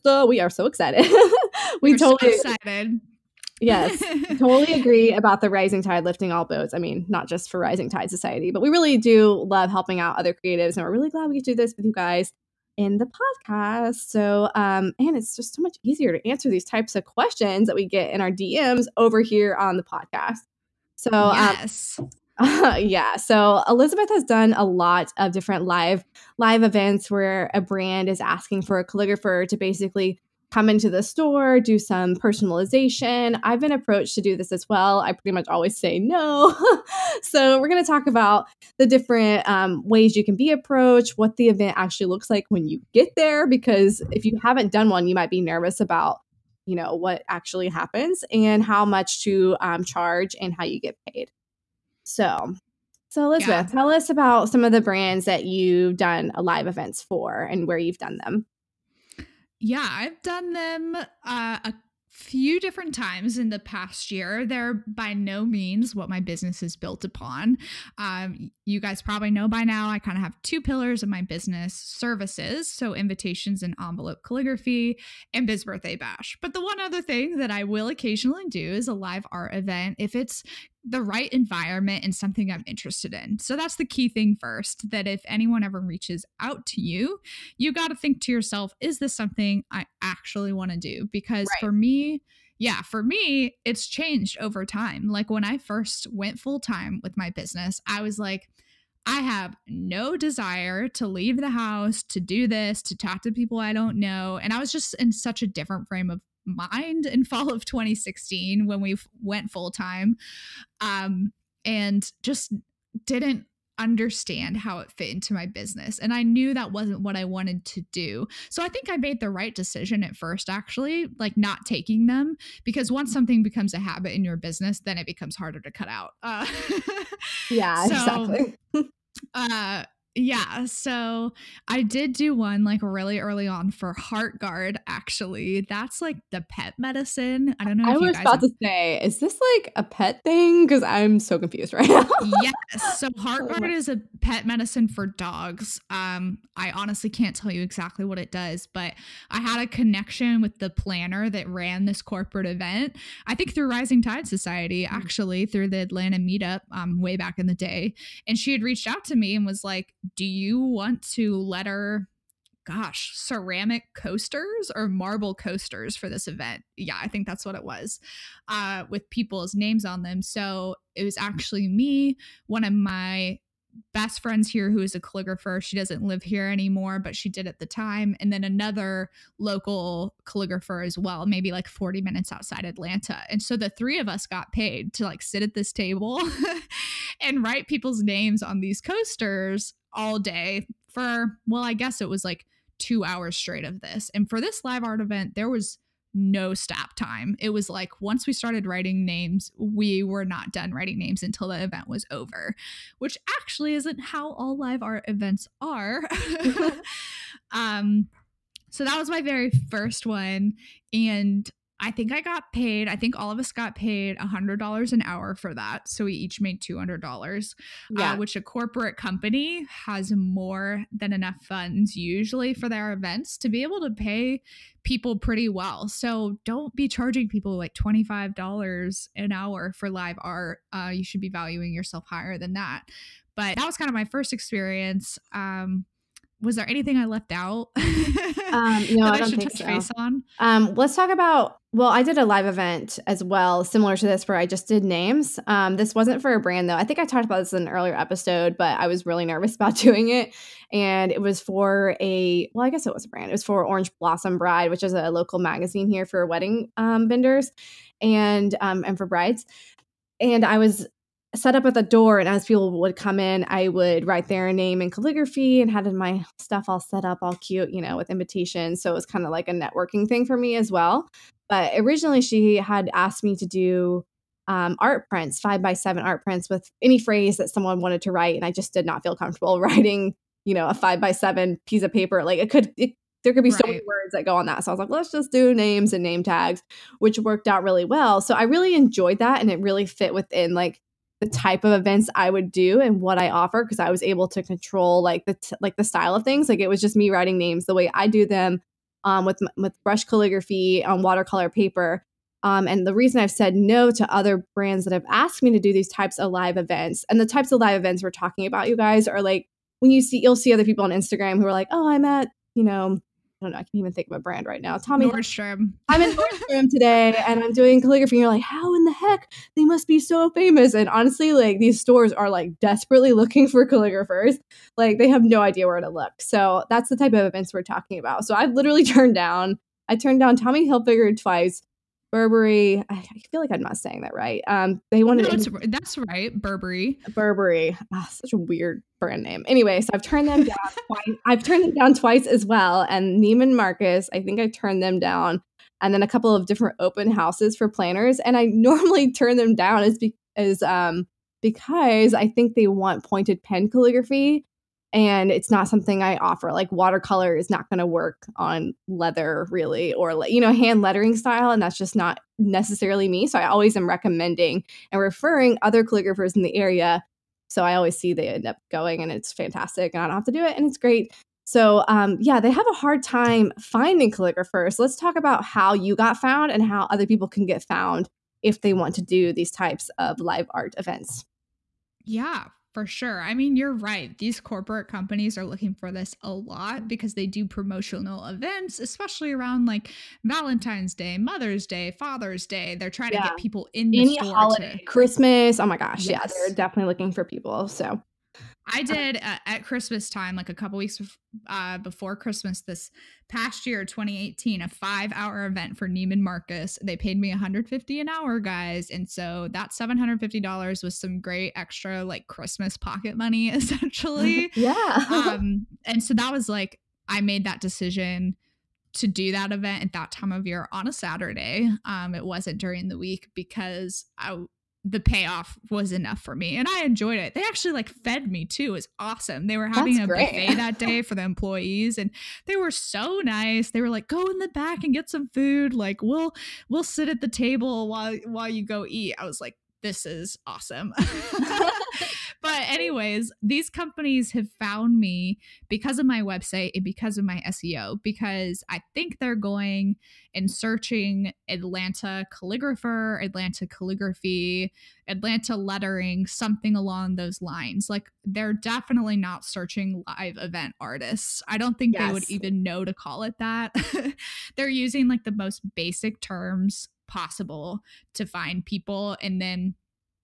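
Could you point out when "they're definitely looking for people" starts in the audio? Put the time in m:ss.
6:36.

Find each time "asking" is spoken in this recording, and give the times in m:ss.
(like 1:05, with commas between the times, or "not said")
0:28.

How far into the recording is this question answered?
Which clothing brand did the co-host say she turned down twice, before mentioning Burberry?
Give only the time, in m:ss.
5:30.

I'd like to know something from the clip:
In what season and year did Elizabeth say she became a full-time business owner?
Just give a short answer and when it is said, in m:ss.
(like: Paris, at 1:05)
fall of 2016, at 1:47.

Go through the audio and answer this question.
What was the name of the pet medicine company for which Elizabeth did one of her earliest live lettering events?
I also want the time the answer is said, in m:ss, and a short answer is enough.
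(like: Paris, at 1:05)
Heartgard, at 2:13.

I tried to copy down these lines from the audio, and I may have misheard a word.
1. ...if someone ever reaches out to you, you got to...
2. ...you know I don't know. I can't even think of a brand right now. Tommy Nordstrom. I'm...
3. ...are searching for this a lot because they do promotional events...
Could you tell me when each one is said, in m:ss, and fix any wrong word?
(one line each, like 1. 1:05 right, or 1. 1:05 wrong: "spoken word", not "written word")
1. 1:25 wrong: "anyone", not "someone"
2. 5:12 right
3. 6:25 wrong: "looking", not "searching".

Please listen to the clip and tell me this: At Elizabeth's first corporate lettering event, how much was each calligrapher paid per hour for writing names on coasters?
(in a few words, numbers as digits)
$100.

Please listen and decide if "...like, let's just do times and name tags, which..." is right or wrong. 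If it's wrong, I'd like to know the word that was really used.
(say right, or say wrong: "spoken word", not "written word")
wrong: "names", not "times".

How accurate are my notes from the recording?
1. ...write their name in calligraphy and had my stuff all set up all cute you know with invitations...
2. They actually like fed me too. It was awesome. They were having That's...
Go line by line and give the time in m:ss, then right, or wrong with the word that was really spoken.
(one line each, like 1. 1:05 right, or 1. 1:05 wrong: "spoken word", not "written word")
1. 4:24 right
2. 7:07 right.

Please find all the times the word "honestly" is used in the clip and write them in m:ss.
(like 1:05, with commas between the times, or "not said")
2:26, 5:20.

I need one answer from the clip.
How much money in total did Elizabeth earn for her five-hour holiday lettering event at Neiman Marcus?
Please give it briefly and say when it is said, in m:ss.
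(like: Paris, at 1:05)
$750, at 6:49.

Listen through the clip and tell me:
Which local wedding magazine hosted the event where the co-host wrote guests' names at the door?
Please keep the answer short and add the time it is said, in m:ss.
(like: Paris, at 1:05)
Orange Blossom Bride, at 4:13.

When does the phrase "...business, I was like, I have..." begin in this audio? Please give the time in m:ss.
1:37.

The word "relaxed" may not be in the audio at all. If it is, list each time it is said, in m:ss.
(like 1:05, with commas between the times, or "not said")
not said.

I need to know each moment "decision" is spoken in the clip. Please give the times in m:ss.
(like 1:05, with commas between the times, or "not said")
1:59, 6:57.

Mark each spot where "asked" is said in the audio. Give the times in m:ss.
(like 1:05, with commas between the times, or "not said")
4:32, 5:05.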